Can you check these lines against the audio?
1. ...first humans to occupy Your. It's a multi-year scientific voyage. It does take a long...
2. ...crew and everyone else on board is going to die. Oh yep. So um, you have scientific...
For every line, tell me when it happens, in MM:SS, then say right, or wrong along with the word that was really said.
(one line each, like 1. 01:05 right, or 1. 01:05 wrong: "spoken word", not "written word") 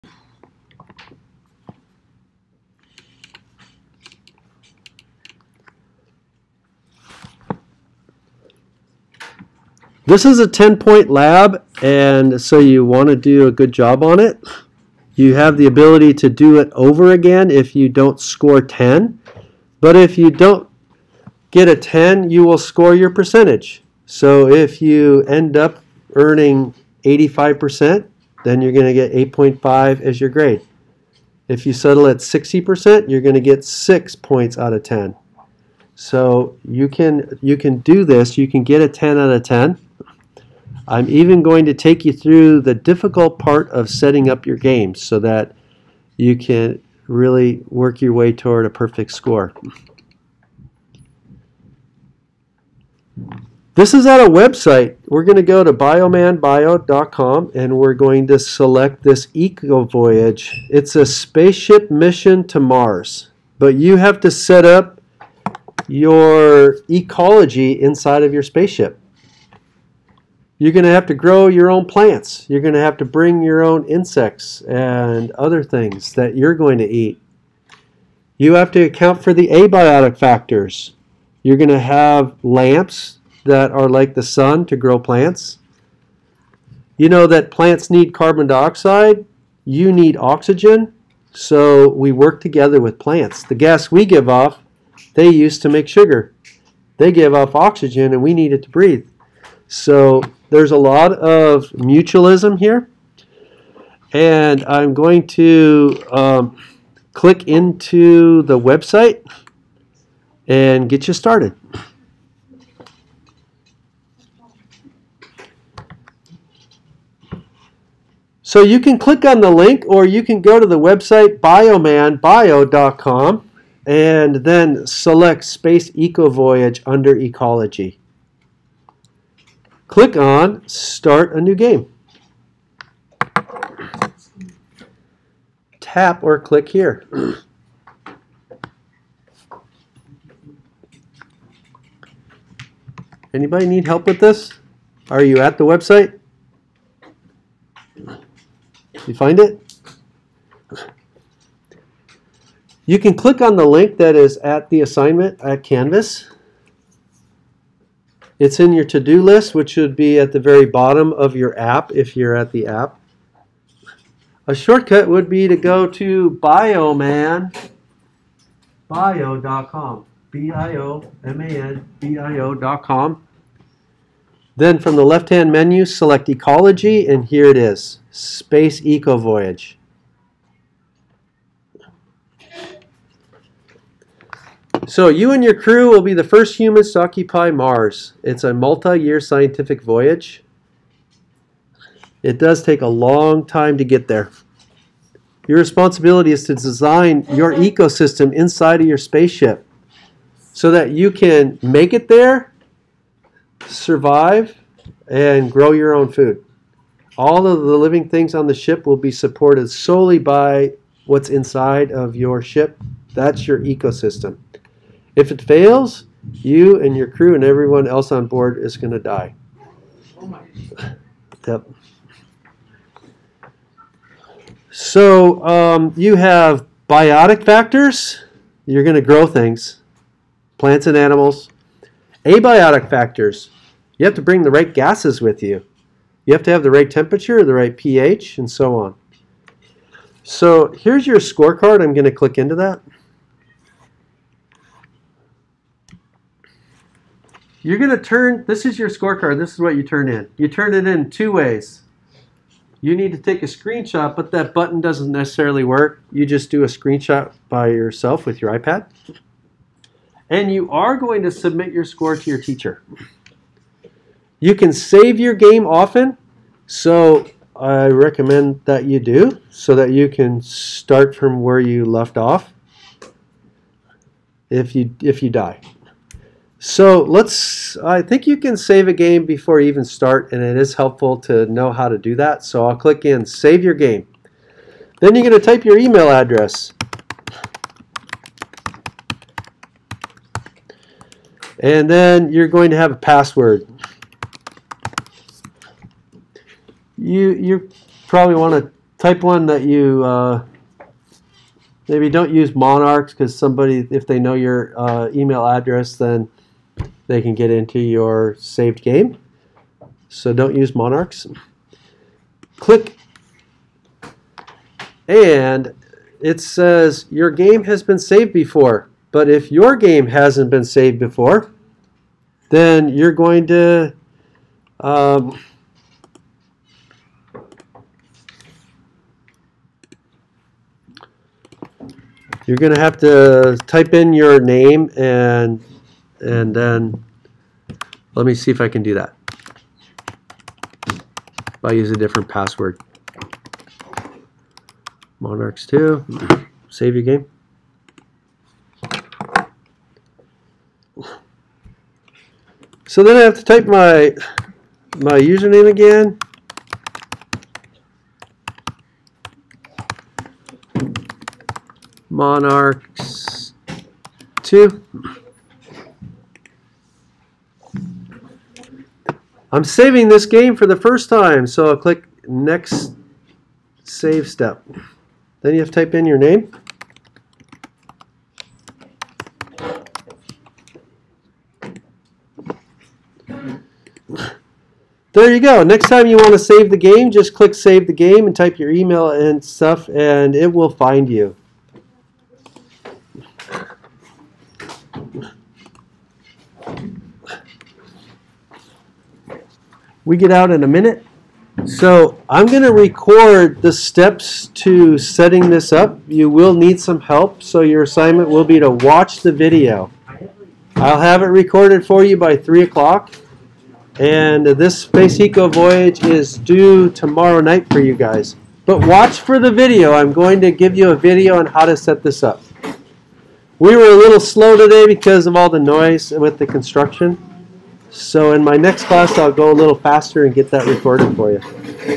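1. 03:06 wrong: "Mars", not "Your"
2. 03:37 wrong: "biotic", not "scientific".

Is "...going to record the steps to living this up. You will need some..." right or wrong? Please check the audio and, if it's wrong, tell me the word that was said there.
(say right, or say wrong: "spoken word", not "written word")
wrong: "setting", not "living".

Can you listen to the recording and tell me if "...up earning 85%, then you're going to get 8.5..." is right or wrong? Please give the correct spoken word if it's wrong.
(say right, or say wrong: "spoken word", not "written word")
right.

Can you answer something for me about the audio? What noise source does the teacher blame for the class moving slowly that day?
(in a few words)
the construction.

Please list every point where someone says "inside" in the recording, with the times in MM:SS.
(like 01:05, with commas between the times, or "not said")
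01:07, 03:18, 03:31.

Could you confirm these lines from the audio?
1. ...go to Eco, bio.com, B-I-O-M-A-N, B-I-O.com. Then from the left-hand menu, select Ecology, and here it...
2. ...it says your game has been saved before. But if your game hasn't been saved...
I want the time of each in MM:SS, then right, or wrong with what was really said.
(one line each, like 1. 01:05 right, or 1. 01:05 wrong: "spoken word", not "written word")
1. 02:45 wrong: "Bioman", not "Eco"
2. 05:16 right.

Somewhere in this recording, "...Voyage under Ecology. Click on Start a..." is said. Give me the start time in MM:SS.
02:06.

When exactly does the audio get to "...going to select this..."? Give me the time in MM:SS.
00:57.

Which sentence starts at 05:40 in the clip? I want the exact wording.
If I use a different password.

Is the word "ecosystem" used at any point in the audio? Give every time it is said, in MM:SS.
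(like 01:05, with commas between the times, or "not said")
03:17, 03:33.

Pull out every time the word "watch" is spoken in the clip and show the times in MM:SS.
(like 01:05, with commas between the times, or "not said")
06:48, 06:58.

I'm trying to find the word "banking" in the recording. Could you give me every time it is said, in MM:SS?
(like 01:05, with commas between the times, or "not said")
not said.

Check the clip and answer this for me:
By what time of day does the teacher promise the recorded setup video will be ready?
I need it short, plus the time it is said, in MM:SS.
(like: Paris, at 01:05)
3 o'clock, at 06:52.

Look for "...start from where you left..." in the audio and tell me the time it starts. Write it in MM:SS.
04:30.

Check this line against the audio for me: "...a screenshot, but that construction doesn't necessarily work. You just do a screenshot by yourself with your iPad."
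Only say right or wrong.
wrong.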